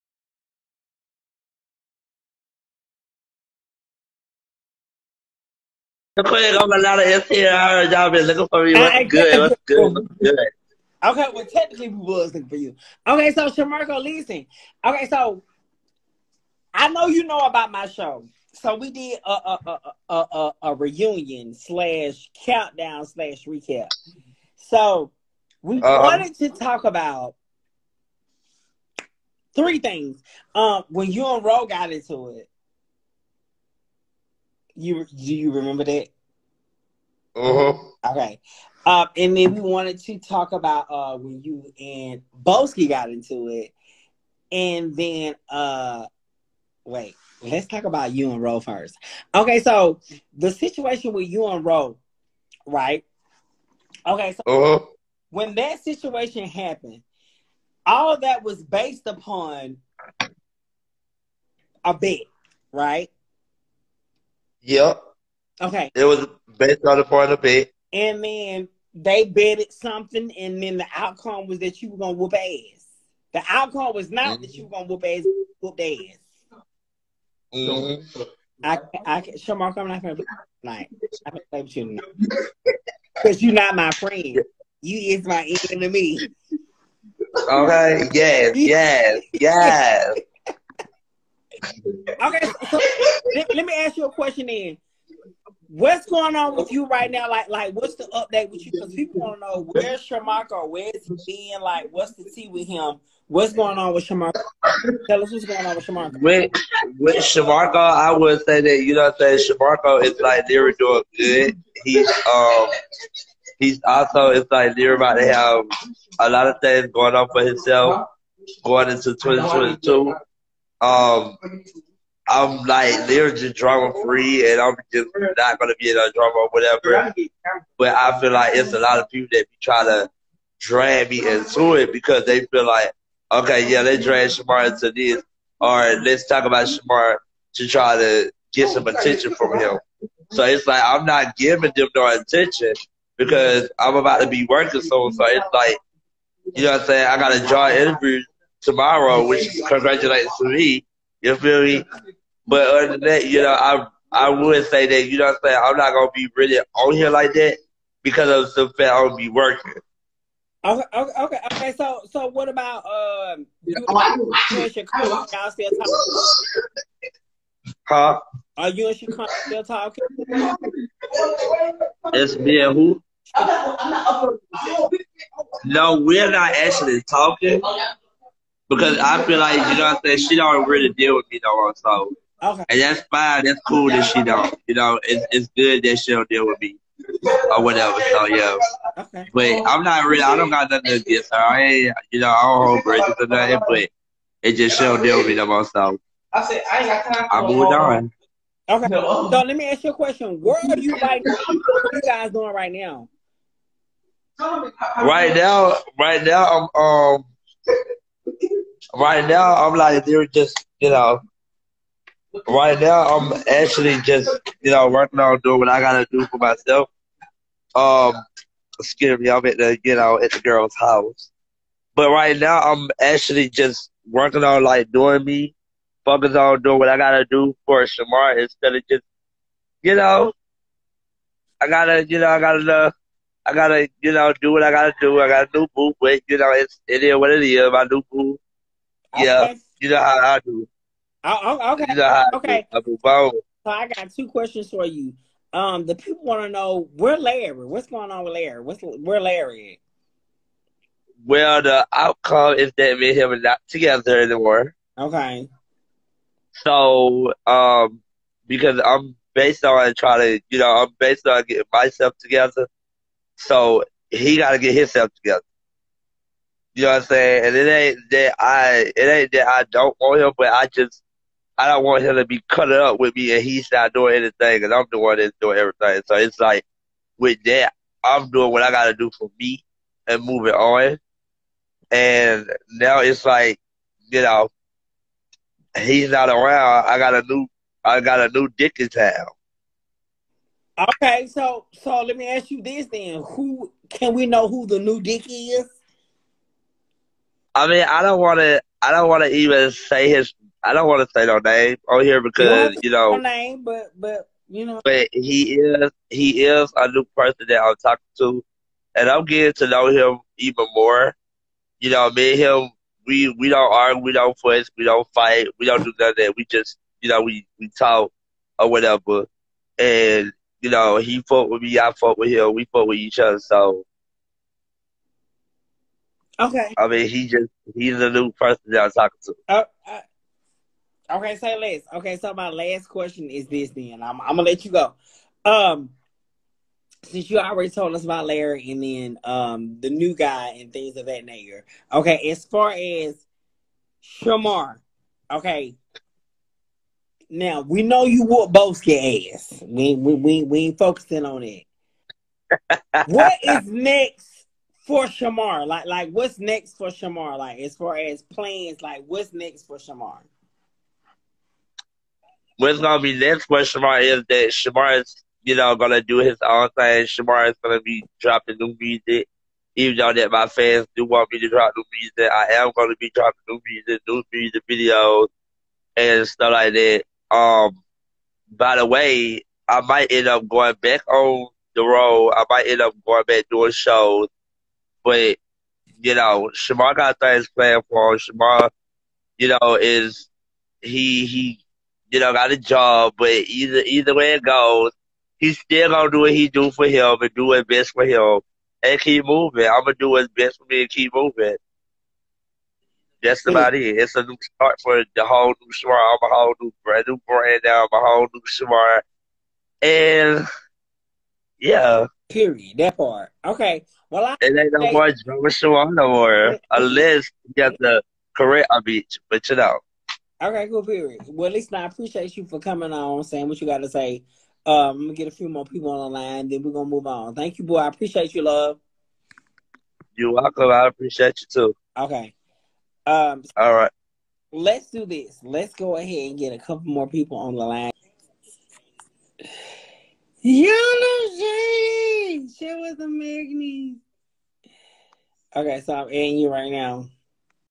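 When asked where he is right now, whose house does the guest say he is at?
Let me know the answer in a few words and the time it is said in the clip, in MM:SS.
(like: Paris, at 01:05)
The girl's house, at 03:40.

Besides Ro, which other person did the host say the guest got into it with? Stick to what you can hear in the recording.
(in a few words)
Boski.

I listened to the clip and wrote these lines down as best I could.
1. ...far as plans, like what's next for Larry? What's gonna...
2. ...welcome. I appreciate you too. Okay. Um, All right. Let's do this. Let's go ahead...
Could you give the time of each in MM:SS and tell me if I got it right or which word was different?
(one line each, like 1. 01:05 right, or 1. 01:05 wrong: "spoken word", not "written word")
1. 05:57 wrong: "Shamar", not "Larry"
2. 07:10 right.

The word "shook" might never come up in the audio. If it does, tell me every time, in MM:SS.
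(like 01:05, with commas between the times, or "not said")
not said.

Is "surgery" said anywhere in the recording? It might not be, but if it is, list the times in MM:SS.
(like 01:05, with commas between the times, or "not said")
not said.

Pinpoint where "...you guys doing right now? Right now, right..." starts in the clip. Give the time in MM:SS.
03:21.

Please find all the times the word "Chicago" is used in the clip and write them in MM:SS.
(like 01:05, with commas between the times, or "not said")
02:44, 02:48.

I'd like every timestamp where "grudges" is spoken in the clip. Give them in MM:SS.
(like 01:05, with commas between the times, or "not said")
03:12.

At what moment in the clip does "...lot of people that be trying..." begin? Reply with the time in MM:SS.
02:08.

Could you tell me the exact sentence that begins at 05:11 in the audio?
You know, me and him, we we don't argue, we don't fuss, we don't fight, we don't do nothing.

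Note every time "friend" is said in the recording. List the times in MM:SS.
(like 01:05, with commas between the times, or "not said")
01:23.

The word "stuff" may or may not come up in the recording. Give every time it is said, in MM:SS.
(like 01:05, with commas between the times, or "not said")
06:16.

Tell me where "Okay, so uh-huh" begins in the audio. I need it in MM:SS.
00:54.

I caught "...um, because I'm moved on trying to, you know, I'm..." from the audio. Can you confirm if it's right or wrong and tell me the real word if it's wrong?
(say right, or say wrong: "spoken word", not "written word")
wrong: "based", not "moved".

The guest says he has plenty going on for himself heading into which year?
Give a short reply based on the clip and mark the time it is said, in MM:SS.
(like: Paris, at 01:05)
2022, at 01:59.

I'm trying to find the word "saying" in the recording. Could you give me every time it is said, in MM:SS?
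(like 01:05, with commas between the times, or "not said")
01:49, 02:26, 02:35, 03:00, 04:27, 07:03.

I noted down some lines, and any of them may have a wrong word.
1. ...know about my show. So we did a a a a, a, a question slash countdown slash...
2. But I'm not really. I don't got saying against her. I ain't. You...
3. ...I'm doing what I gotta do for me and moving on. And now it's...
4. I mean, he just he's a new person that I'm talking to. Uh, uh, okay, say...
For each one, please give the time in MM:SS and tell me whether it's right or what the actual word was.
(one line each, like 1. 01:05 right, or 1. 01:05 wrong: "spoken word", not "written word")
1. 00:17 wrong: "reunion", not "question"
2. 03:09 wrong: "nothing", not "saying"
3. 04:38 right
4. 05:26 right.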